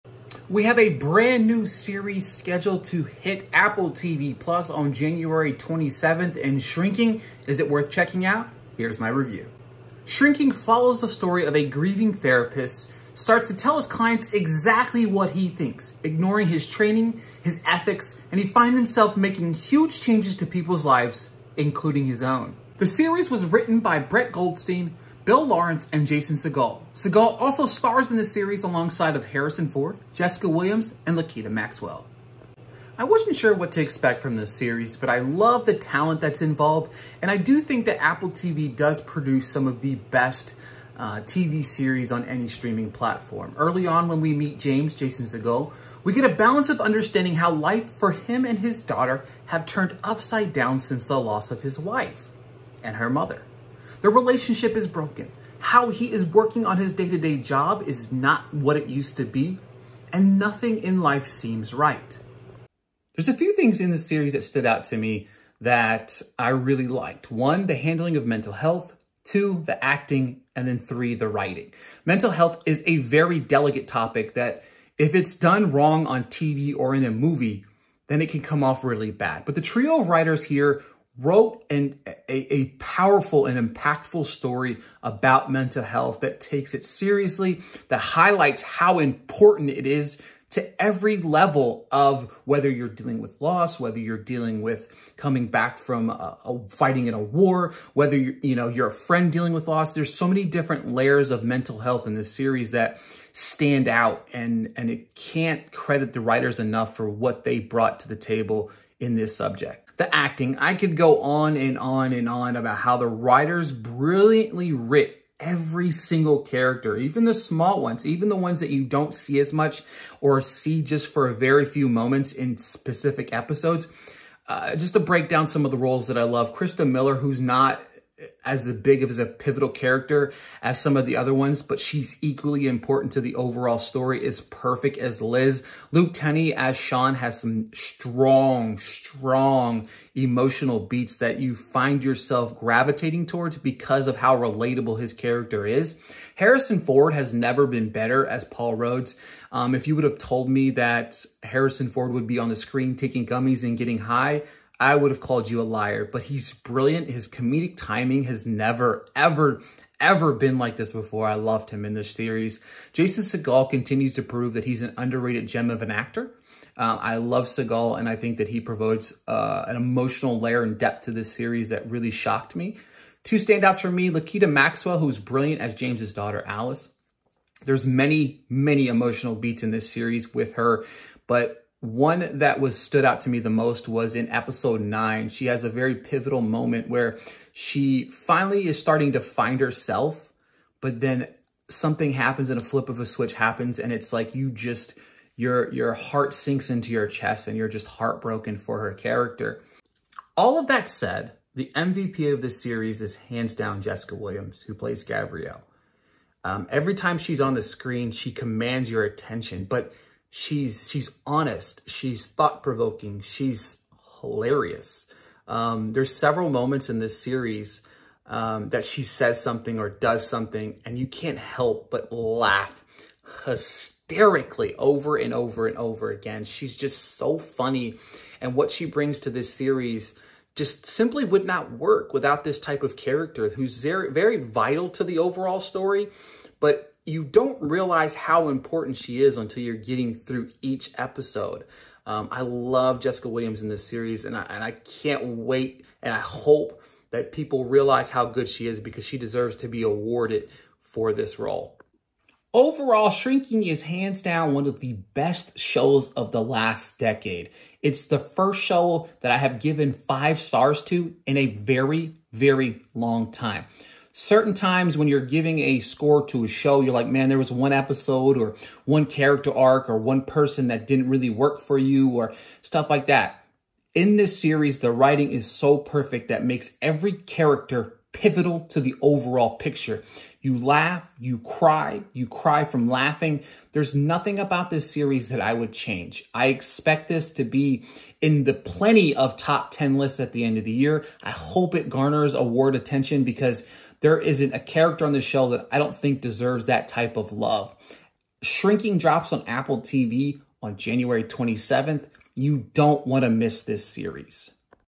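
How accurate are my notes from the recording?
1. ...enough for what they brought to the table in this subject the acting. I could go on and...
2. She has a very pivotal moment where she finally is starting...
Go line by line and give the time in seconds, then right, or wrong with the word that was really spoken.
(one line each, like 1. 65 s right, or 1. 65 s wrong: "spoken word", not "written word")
1. 106 s right
2. 185 s right.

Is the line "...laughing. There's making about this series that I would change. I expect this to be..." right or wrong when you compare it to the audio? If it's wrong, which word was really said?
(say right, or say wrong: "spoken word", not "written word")
wrong: "nothing", not "making".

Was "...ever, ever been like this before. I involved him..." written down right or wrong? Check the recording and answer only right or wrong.
wrong.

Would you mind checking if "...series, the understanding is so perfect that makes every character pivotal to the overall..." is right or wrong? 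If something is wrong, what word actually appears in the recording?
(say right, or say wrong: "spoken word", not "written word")
wrong: "writing", not "understanding".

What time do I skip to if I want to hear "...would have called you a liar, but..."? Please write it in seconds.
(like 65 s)
154 s.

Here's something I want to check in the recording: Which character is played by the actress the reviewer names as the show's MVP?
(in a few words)
Gabrielle.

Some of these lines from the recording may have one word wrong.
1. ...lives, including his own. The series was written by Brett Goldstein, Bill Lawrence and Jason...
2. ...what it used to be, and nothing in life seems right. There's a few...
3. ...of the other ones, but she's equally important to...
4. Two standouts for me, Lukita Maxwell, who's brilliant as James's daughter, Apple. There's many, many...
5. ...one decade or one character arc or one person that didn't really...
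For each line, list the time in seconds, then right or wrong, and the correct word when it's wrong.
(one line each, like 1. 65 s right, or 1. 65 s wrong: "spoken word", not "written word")
1. 20 s right
2. 58 s right
3. 130 s right
4. 173 s wrong: "Alice", not "Apple"
5. 267 s wrong: "episode", not "decade".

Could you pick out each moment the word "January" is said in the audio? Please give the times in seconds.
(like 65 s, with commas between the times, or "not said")
4 s, 300 s.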